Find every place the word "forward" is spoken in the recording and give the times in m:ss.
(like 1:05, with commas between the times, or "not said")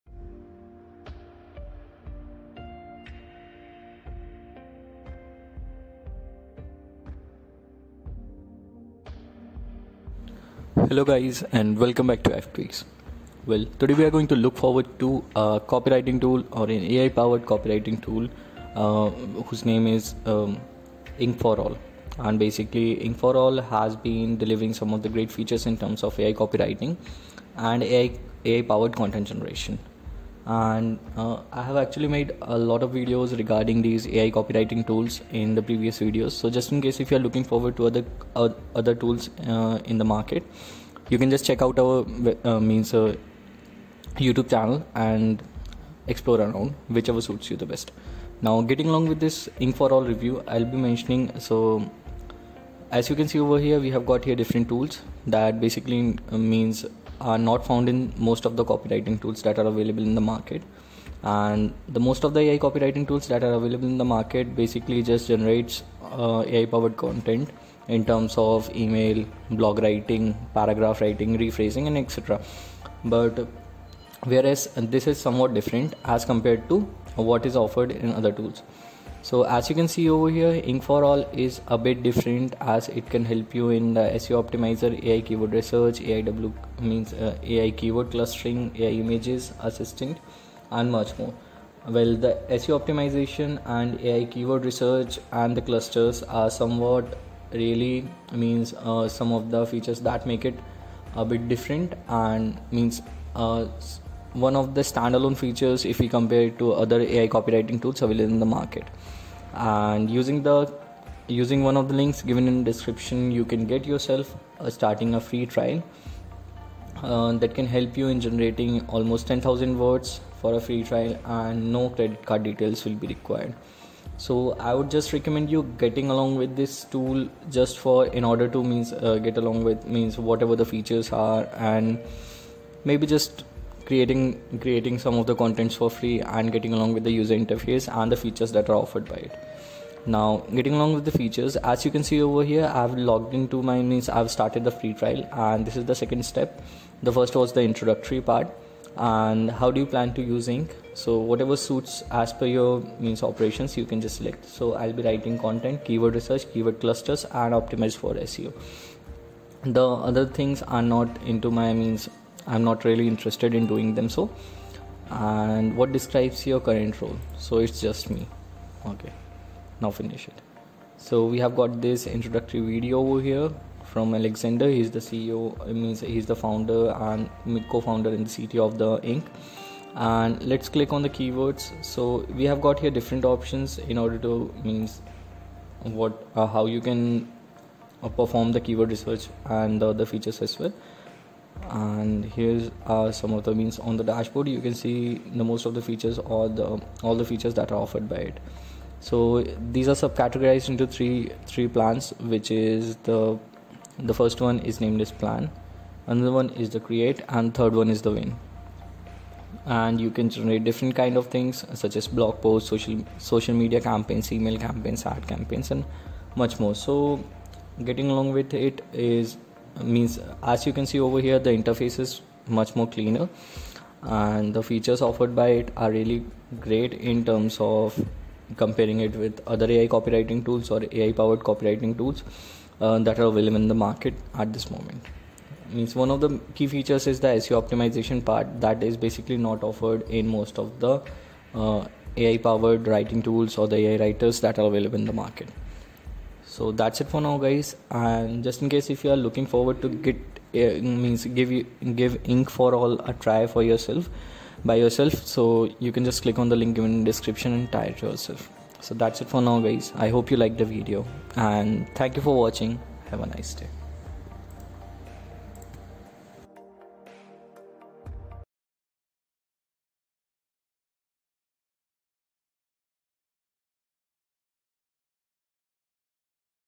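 0:14, 0:37, 4:09.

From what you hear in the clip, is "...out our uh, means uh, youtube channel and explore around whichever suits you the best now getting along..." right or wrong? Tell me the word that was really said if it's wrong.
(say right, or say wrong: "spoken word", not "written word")
right.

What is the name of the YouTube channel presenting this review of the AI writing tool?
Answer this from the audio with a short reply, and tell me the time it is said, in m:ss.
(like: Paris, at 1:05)
FPX, at 0:12.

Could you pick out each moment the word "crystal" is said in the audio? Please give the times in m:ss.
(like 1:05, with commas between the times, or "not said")
not said.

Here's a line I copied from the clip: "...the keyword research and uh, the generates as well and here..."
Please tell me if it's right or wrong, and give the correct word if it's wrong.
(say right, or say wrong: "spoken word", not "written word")
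wrong: "features", not "generates".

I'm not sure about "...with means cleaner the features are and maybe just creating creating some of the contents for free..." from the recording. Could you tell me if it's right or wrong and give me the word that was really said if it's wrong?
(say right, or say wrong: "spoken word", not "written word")
wrong: "whatever", not "cleaner".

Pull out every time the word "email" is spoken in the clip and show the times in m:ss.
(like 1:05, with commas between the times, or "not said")
1:08, 3:34.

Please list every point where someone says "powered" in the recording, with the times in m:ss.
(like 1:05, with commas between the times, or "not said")
0:17, 0:28, 1:06, 3:51, 4:02.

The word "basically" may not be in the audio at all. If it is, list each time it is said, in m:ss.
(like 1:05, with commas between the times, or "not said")
0:22, 0:55, 1:04, 3:58.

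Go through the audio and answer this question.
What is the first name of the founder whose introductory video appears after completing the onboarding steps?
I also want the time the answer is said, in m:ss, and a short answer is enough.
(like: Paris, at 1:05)
Alexander, at 2:54.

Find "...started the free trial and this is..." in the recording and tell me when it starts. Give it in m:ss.
2:24.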